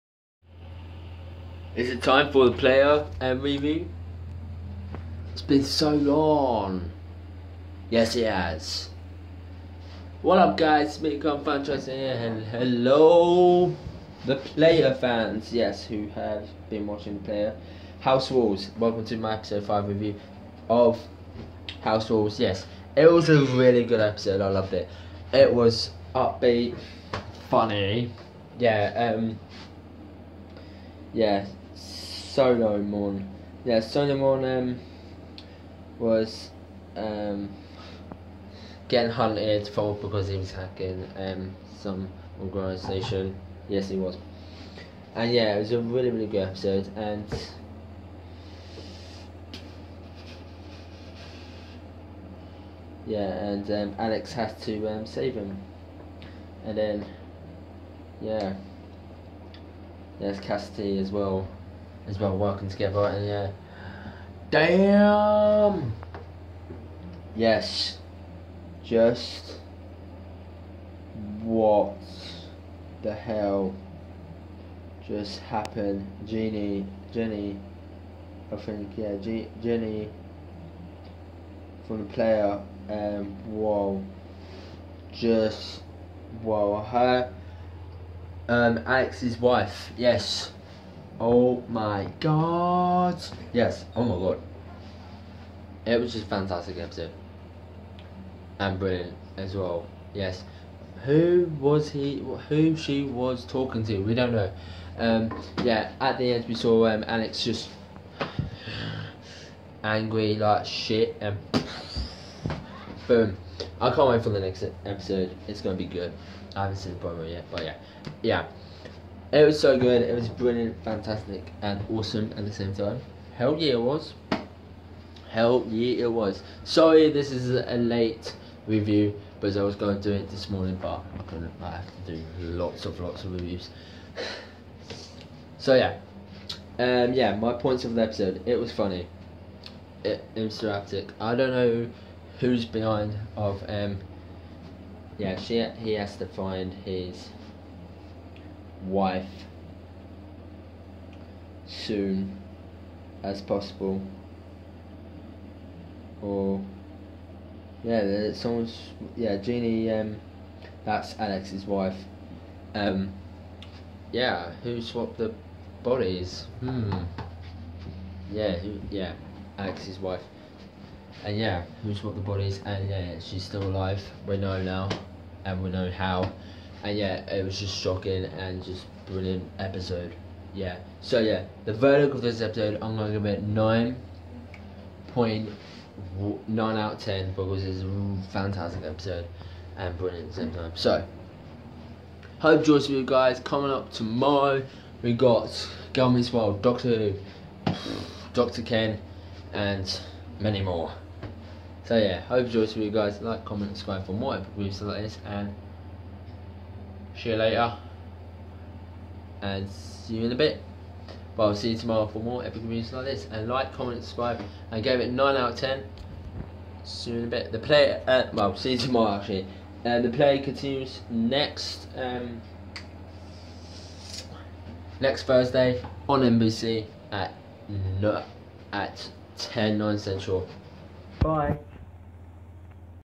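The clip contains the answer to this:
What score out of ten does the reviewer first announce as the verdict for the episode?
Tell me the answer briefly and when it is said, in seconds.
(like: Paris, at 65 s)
9.9, at 183 s.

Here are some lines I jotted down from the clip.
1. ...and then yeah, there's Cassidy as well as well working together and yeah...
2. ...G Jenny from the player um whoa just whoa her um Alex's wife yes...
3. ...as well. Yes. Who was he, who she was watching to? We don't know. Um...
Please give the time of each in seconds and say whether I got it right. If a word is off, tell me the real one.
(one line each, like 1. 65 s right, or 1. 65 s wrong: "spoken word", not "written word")
1. 56 s right
2. 79 s right
3. 99 s wrong: "talking", not "watching".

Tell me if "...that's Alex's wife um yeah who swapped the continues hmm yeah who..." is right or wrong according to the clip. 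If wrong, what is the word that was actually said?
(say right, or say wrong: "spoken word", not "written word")
wrong: "bodies", not "continues".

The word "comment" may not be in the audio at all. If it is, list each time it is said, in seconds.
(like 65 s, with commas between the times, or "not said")
203 s, 213 s.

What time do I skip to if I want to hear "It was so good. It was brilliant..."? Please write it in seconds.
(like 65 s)
119 s.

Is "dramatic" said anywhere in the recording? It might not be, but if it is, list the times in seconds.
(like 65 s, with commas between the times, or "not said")
140 s.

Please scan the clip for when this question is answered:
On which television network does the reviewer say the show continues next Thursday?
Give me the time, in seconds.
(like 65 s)
226 s.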